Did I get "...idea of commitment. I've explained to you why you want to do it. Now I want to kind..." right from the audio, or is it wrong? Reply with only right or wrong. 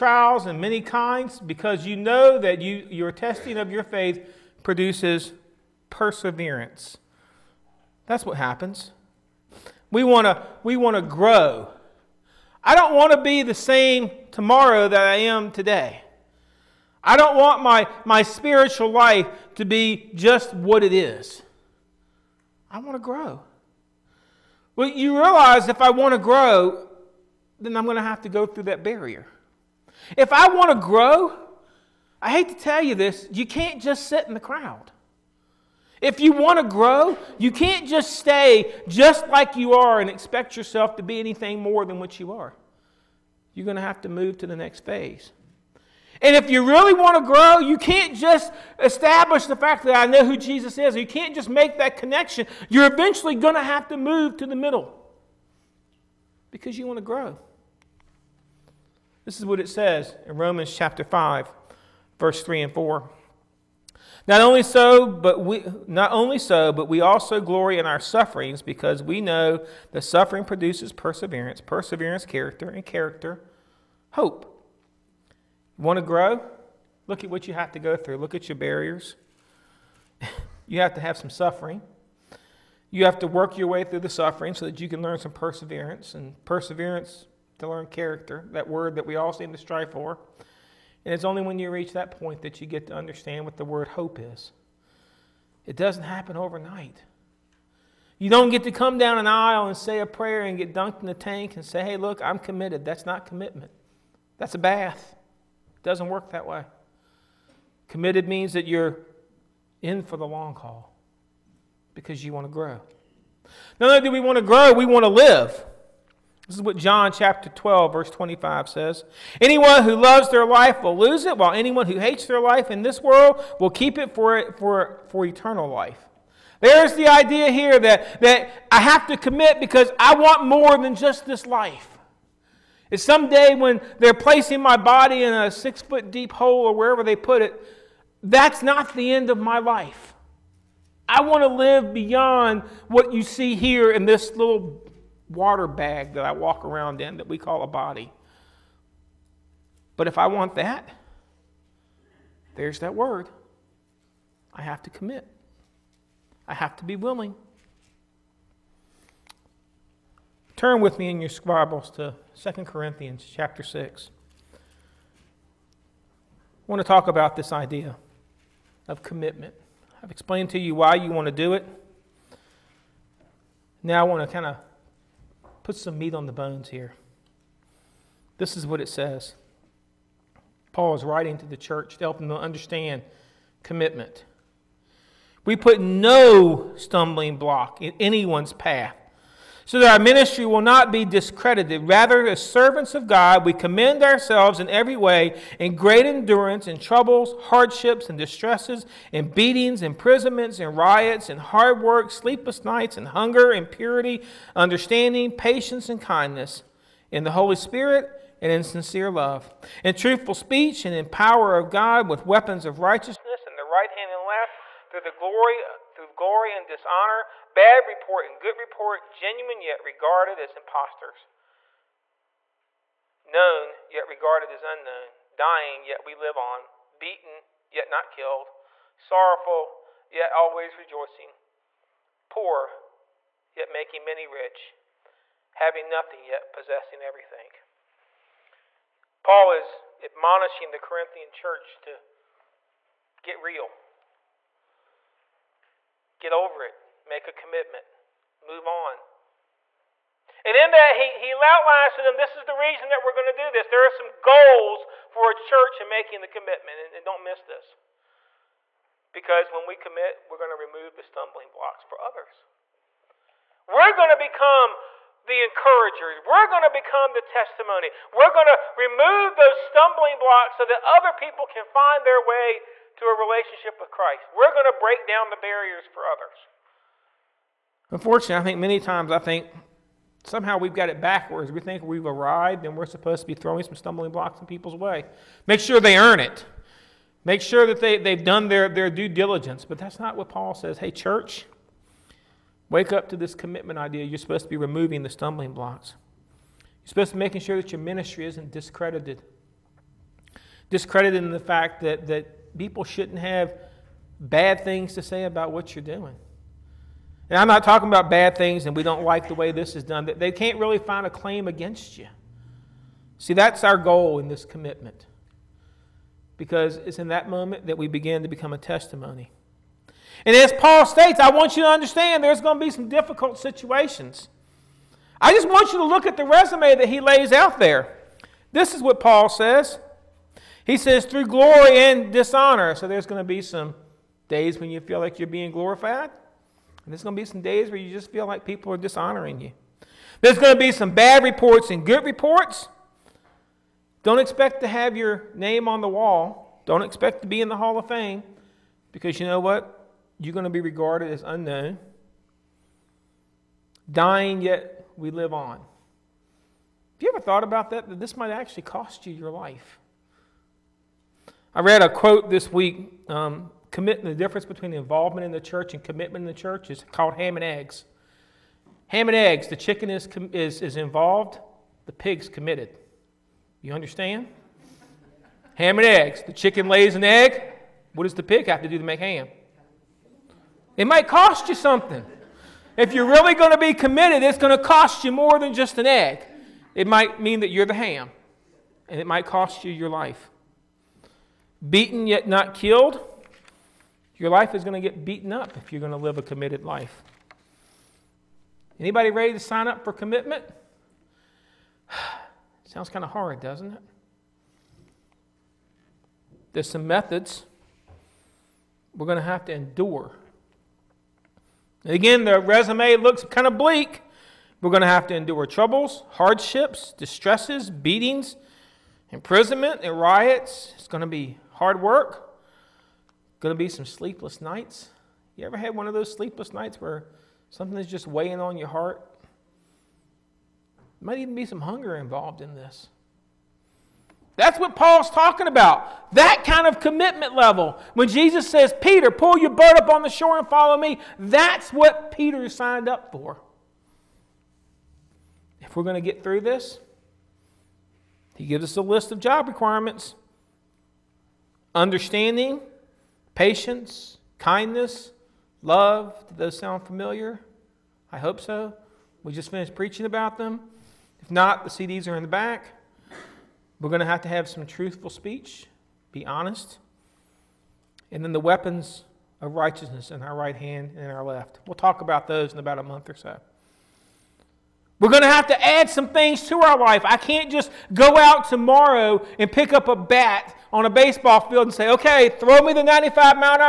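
right.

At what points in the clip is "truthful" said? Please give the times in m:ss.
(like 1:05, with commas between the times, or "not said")
3:29, 7:44.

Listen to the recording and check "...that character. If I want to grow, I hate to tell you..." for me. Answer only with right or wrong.
wrong.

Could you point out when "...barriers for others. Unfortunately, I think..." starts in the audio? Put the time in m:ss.
4:35.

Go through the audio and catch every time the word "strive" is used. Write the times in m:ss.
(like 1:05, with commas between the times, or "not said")
1:29.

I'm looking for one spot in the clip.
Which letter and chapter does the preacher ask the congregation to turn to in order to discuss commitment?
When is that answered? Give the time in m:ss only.
2:42.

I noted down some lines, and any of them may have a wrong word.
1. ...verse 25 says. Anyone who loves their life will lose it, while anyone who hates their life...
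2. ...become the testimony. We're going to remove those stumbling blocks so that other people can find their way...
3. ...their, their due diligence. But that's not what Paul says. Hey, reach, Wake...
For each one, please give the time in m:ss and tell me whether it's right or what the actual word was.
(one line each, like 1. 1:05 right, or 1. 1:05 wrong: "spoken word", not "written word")
1. 1:57 right
2. 4:26 right
3. 4:48 wrong: "church", not "reach".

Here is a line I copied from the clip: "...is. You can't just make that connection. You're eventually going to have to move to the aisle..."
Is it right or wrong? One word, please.
wrong.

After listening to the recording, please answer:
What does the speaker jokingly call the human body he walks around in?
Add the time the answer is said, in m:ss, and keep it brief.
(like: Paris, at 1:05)
Water bag, at 2:25.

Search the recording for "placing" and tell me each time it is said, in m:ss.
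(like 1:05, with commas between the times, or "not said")
2:14.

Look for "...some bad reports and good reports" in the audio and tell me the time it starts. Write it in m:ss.
5:40.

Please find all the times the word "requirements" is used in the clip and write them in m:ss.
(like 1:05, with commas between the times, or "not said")
7:29.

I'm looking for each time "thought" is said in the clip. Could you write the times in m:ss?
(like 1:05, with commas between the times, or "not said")
5:57.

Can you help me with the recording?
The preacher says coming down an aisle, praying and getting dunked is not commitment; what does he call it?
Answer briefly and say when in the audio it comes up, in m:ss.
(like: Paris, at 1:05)
A bath, at 1:44.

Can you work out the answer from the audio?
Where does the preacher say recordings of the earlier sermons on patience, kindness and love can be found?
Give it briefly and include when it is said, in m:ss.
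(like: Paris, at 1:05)
In the back, at 7:41.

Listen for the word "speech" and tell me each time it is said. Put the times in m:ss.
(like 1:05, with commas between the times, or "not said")
3:30, 7:45.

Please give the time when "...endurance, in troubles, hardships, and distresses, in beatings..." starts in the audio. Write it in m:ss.
3:16.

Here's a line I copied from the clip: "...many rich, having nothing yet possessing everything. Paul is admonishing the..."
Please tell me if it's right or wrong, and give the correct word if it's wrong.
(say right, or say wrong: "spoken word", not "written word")
right.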